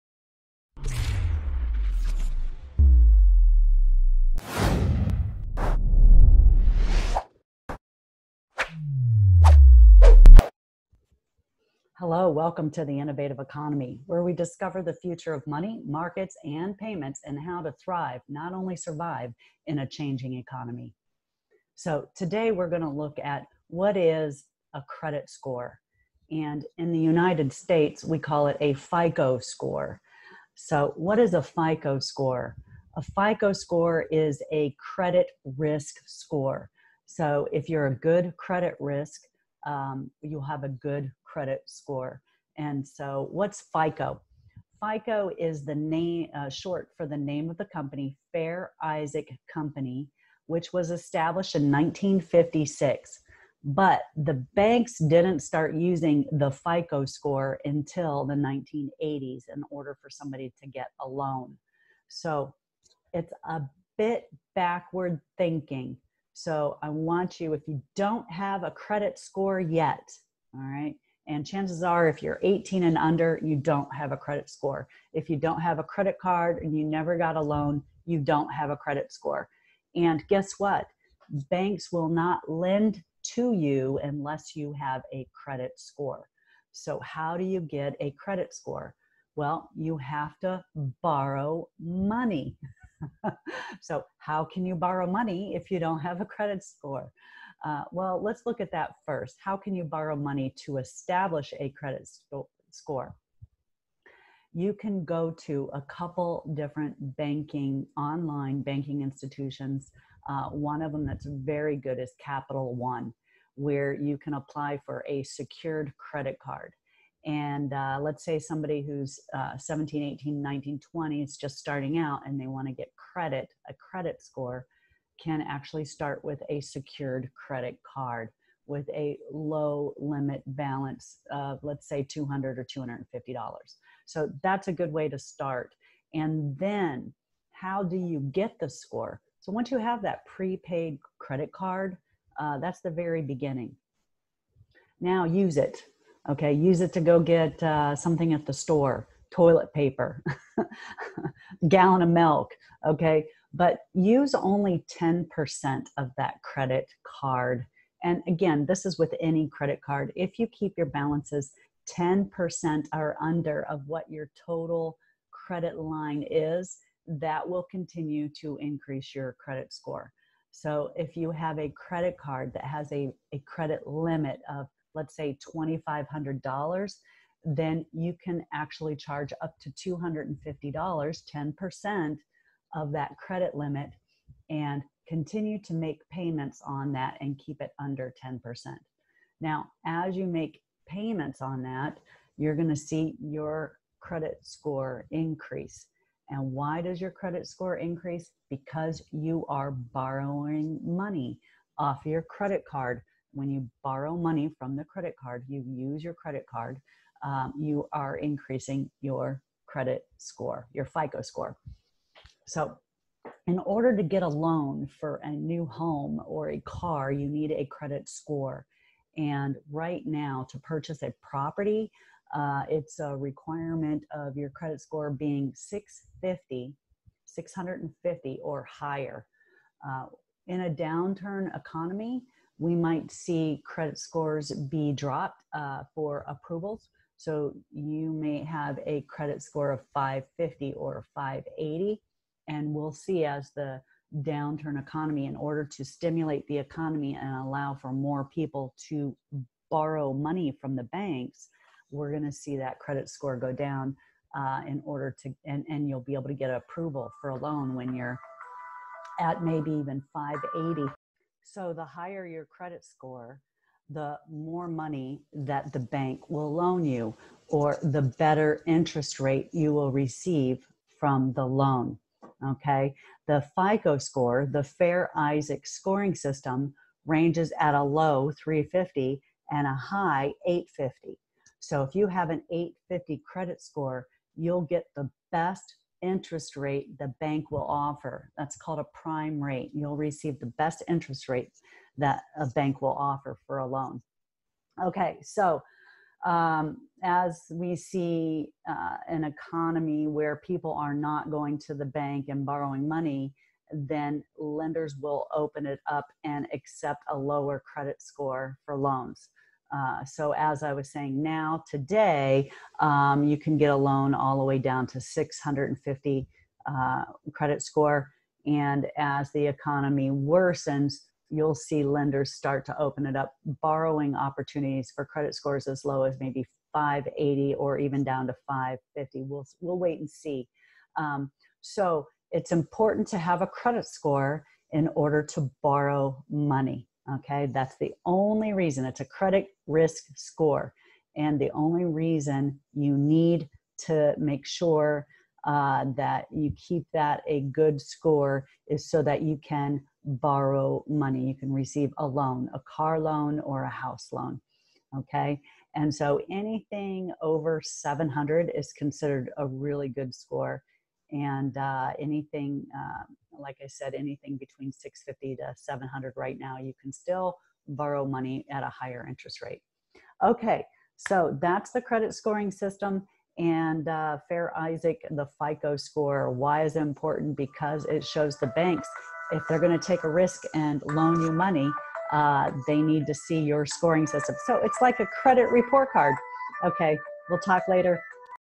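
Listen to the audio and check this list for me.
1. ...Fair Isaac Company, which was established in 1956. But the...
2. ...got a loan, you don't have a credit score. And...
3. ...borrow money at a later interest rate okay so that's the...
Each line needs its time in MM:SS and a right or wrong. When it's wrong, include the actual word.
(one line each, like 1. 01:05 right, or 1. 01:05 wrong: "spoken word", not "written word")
1. 00:48 right
2. 01:17 right
3. 06:07 wrong: "higher", not "later".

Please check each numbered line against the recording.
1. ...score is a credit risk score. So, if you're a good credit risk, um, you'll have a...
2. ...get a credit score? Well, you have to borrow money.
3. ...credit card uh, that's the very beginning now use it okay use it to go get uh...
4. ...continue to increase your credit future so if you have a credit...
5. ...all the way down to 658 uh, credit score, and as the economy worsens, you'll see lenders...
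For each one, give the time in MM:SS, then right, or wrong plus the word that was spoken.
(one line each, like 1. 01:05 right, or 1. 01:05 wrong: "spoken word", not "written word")
1. 00:33 right
2. 01:27 right
3. 02:21 right
4. 02:47 wrong: "score", not "future"
5. 05:14 wrong: "650", not "658".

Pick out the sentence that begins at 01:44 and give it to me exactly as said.
You can go to a couple different banking, online banking institutions.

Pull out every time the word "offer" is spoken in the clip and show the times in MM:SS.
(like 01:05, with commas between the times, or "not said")
04:47, 04:52.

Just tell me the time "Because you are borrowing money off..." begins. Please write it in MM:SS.
03:18.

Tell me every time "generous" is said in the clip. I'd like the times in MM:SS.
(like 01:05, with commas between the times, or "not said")
not said.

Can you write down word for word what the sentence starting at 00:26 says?
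And in the United States, we call it a FICO score.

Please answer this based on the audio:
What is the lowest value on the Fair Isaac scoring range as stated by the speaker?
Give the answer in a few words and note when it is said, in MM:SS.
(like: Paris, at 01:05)
350, at 04:38.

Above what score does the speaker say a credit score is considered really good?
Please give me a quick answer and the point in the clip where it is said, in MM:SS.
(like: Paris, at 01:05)
700, at 05:56.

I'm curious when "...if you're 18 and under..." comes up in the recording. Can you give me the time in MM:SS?
01:12.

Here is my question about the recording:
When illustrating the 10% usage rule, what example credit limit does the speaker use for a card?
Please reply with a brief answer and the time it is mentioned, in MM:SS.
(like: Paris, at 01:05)
$2,500, at 02:55.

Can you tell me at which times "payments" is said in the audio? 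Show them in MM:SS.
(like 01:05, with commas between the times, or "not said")
00:16, 03:06, 03:10.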